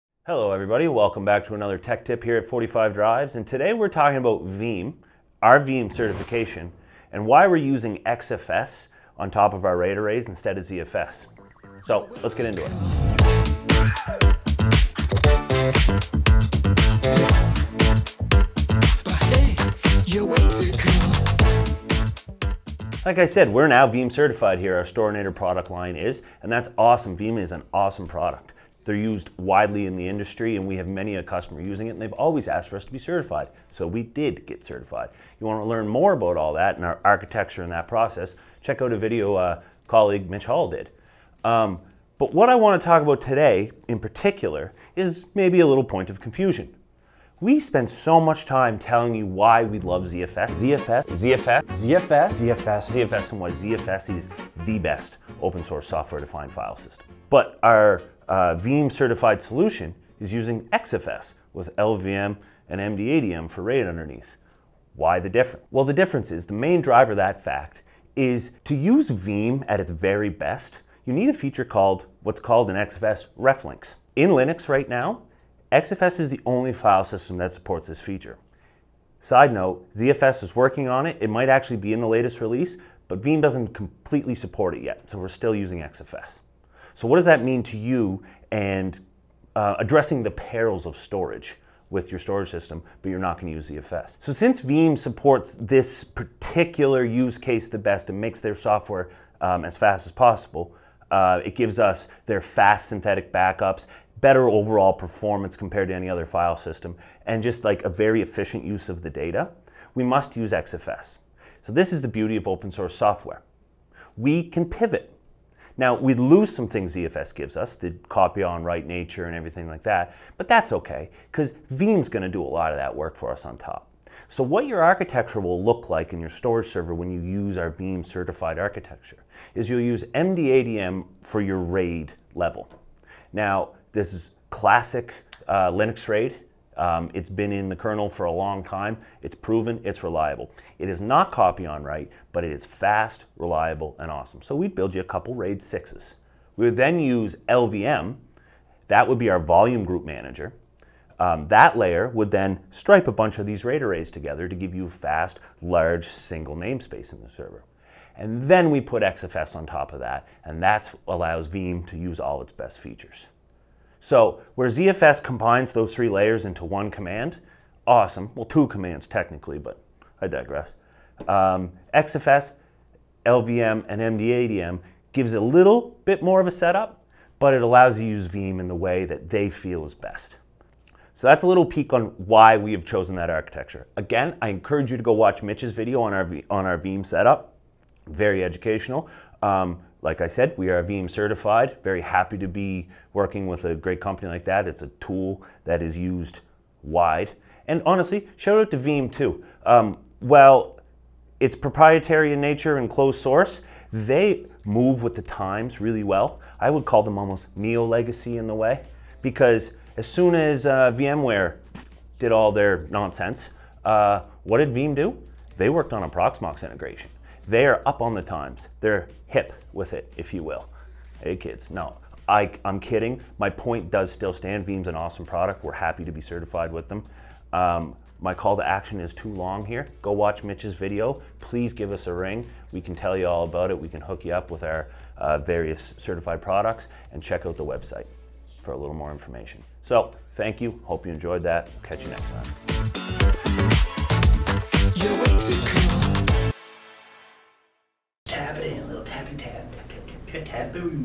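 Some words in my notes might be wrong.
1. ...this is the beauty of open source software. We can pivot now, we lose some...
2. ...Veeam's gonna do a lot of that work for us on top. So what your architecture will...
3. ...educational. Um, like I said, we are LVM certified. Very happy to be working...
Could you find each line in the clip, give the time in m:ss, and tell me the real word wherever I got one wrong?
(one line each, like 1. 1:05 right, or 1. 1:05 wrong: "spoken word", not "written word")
1. 1:51 right
2. 2:01 right
3. 3:08 wrong: "Veeam", not "LVM".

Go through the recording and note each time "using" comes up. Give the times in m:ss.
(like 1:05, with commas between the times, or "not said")
0:07, 0:31, 1:00, 1:25.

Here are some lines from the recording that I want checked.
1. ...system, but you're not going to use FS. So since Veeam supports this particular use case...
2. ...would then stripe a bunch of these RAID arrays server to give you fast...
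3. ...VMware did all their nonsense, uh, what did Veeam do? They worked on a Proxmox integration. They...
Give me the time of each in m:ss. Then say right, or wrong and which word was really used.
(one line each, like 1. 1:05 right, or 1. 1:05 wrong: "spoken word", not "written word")
1. 1:32 right
2. 2:32 wrong: "together", not "server"
3. 3:30 right.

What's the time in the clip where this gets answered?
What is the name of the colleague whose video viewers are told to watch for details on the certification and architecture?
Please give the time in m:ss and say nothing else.
0:40.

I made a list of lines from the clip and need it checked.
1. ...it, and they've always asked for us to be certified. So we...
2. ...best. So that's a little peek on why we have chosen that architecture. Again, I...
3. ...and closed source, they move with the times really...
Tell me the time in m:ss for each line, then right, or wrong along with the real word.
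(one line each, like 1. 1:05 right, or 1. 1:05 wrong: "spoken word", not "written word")
1. 0:31 right
2. 2:59 right
3. 3:22 right.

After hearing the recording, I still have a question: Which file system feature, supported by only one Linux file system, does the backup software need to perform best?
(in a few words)
XFS reflinks.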